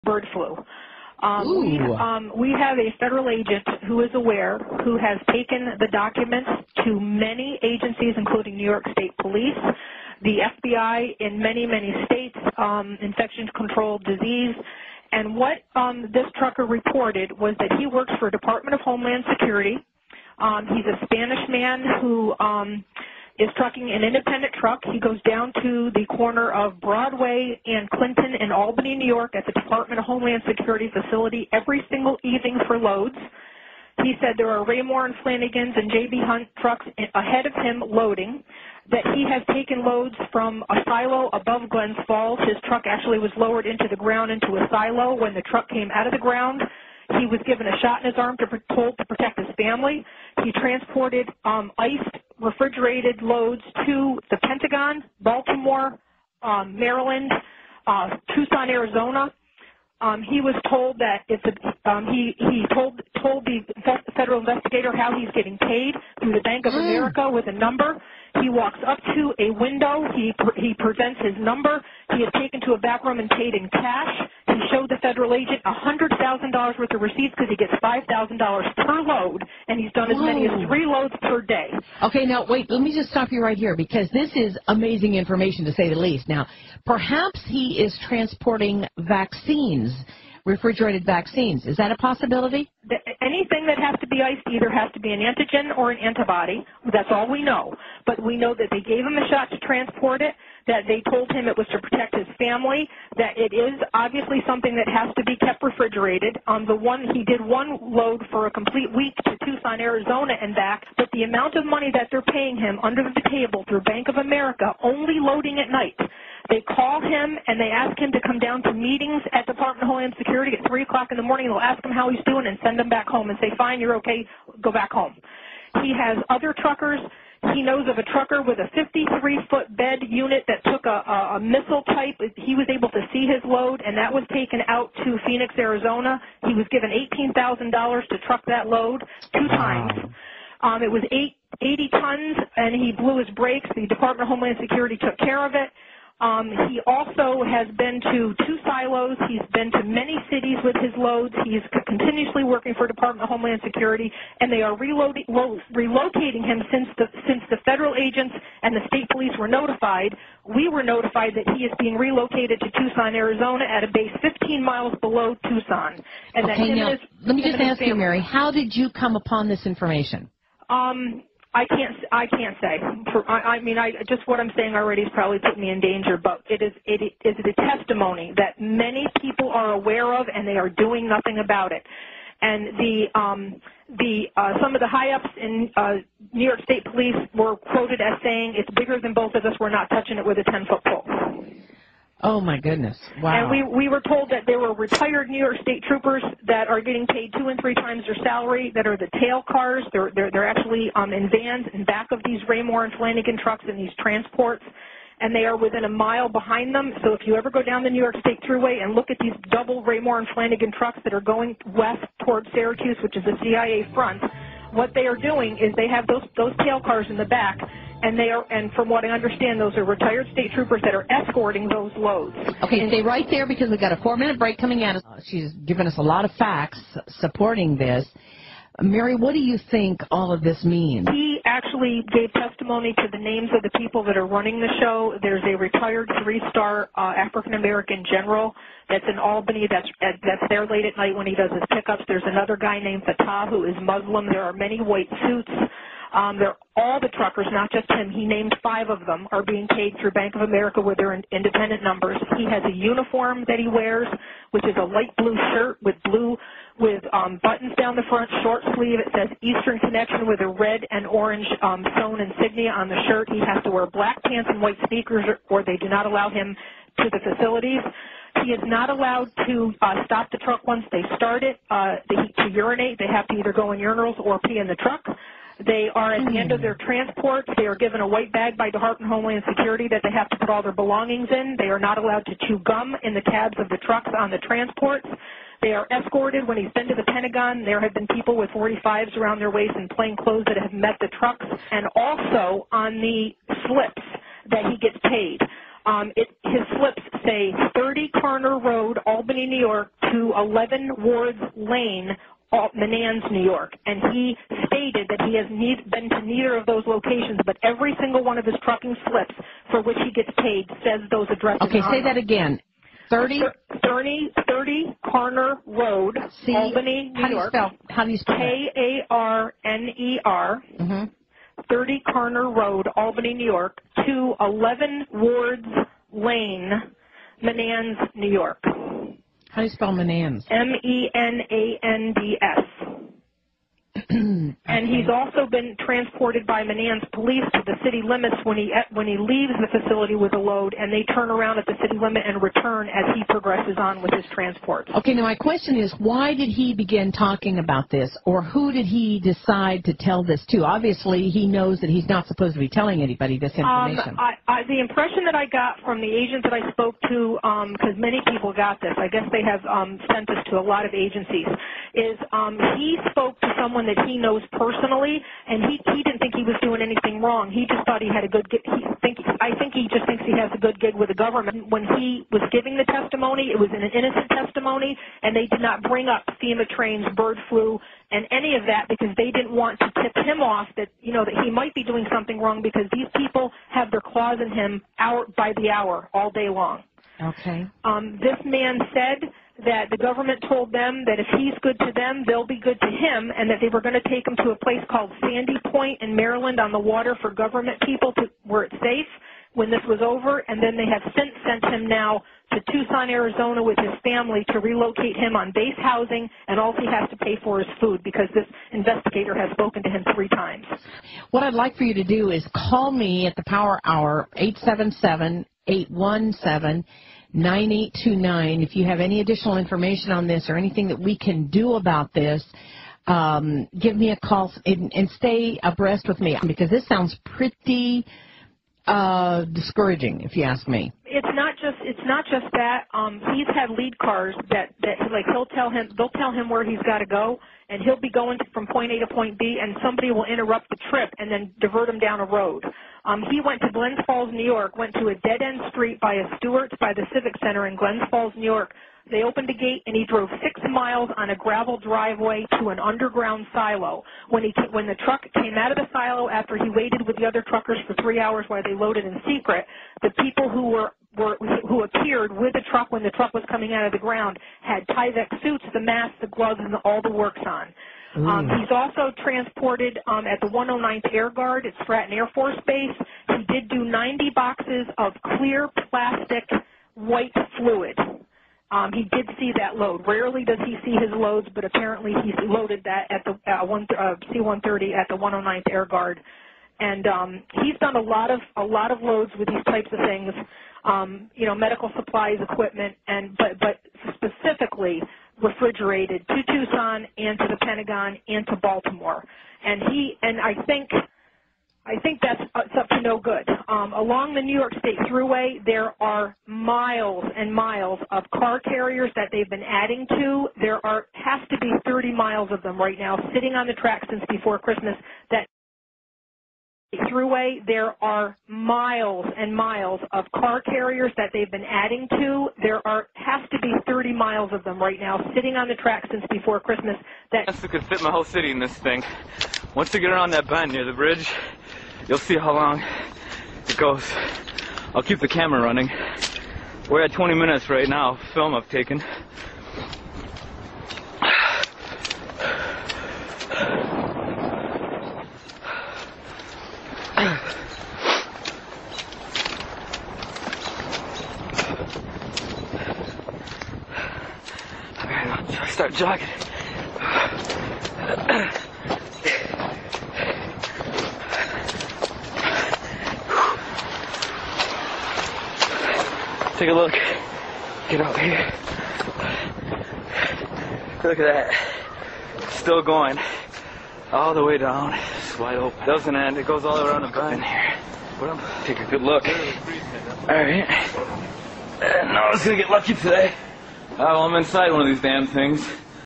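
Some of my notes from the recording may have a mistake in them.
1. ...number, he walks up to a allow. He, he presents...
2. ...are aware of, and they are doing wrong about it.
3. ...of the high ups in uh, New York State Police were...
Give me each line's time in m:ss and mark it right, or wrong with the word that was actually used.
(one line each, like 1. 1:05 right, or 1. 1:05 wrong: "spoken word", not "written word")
1. 1:07 wrong: "window", not "allow"
2. 2:59 wrong: "nothing", not "wrong"
3. 3:04 right.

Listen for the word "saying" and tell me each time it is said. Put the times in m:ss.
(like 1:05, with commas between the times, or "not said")
2:54, 3:08.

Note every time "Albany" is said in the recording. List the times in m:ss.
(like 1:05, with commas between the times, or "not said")
0:28, 3:59, 4:59, 5:16, 5:22.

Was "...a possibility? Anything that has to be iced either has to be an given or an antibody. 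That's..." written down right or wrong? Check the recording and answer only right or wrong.
wrong.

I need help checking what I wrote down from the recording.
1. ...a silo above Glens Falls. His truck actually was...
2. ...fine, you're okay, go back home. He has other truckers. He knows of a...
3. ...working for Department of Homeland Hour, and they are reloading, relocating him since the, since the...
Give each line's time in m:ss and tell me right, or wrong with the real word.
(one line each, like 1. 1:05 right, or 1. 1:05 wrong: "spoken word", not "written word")
1. 0:40 right
2. 2:03 right
3. 2:32 wrong: "Security", not "Hour".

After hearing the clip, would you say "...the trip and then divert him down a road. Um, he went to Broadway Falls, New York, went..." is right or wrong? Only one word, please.
wrong.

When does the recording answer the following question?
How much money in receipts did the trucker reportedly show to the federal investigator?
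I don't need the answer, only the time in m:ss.
1:15.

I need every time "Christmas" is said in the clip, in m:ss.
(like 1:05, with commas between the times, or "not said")
8:34, 8:46.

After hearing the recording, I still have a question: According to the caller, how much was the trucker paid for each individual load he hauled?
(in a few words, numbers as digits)
$5,000.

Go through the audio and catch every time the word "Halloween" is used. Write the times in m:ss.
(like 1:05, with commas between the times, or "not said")
not said.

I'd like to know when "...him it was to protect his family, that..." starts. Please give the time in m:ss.
1:41.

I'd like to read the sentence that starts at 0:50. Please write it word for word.
He transported um, iced refrigerated loads to the Pentagon, Baltimore, um, Maryland, uh, Tucson, Arizona.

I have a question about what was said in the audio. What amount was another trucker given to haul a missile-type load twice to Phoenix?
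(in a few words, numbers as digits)
$18,000.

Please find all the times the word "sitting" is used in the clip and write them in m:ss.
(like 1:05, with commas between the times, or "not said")
8:33, 8:45.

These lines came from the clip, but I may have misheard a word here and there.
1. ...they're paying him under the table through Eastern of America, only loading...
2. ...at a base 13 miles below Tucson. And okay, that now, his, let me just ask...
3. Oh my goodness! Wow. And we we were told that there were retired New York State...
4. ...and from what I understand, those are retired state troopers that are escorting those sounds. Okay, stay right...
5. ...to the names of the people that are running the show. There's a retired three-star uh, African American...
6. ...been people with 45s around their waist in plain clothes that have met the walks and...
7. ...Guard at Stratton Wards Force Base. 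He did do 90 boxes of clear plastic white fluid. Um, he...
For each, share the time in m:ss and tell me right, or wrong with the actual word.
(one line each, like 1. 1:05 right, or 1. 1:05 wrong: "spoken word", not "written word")
1. 1:52 wrong: "Bank", not "Eastern"
2. 2:43 wrong: "15", not "13"
3. 3:12 right
4. 3:38 wrong: "loads", not "sounds"
5. 3:52 right
6. 4:47 wrong: "trucks", not "walks"
7. 7:51 wrong: "Air", not "Wards".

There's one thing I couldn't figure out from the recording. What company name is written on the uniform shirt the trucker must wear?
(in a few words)
Eastern Connection.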